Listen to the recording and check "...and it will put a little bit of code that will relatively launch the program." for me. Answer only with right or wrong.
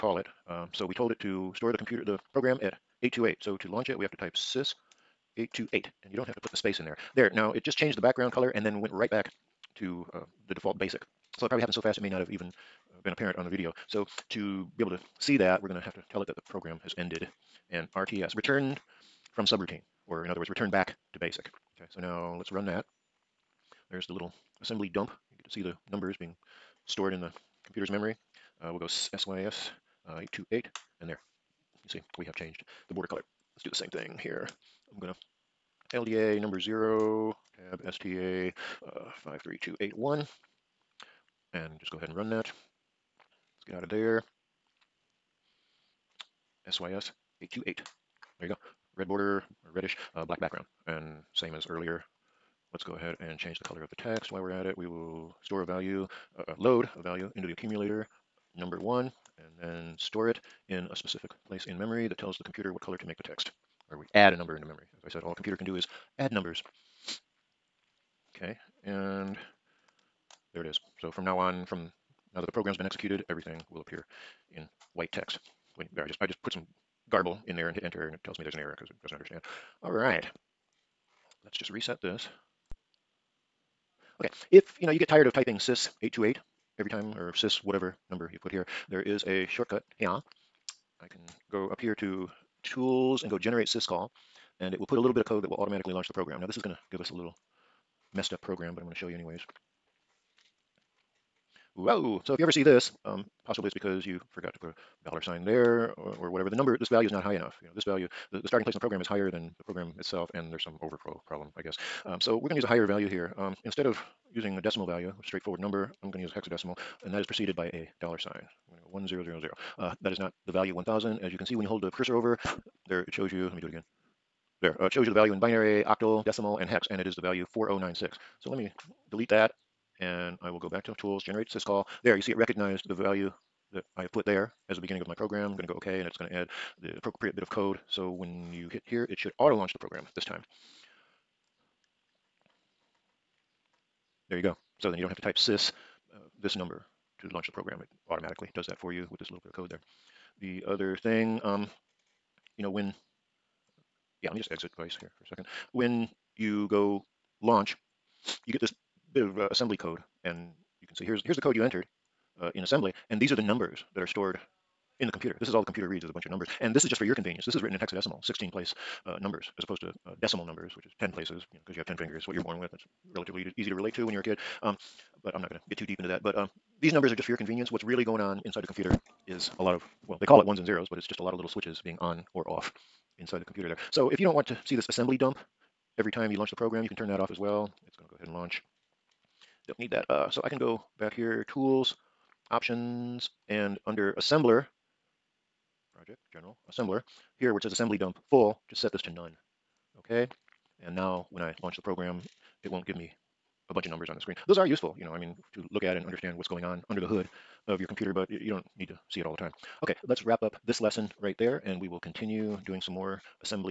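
wrong.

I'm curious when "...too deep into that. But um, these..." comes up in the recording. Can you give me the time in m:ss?
2:55.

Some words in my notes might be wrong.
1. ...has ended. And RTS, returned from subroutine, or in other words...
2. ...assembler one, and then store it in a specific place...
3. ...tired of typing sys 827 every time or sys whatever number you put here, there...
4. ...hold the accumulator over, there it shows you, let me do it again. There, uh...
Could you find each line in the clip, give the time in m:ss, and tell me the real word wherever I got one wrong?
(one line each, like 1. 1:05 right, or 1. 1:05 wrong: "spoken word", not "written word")
1. 0:16 right
2. 0:58 wrong: "number", not "assembler"
3. 1:25 wrong: "828", not "827"
4. 2:01 wrong: "cursor", not "accumulator".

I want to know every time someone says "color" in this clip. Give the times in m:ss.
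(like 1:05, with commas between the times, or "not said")
0:08, 0:33, 0:53, 1:02.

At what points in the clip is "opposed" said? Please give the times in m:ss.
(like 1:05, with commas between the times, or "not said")
2:49.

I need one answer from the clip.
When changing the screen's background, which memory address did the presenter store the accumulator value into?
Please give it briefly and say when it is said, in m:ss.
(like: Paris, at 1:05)
53281, at 0:39.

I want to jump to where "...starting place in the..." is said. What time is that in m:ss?
1:48.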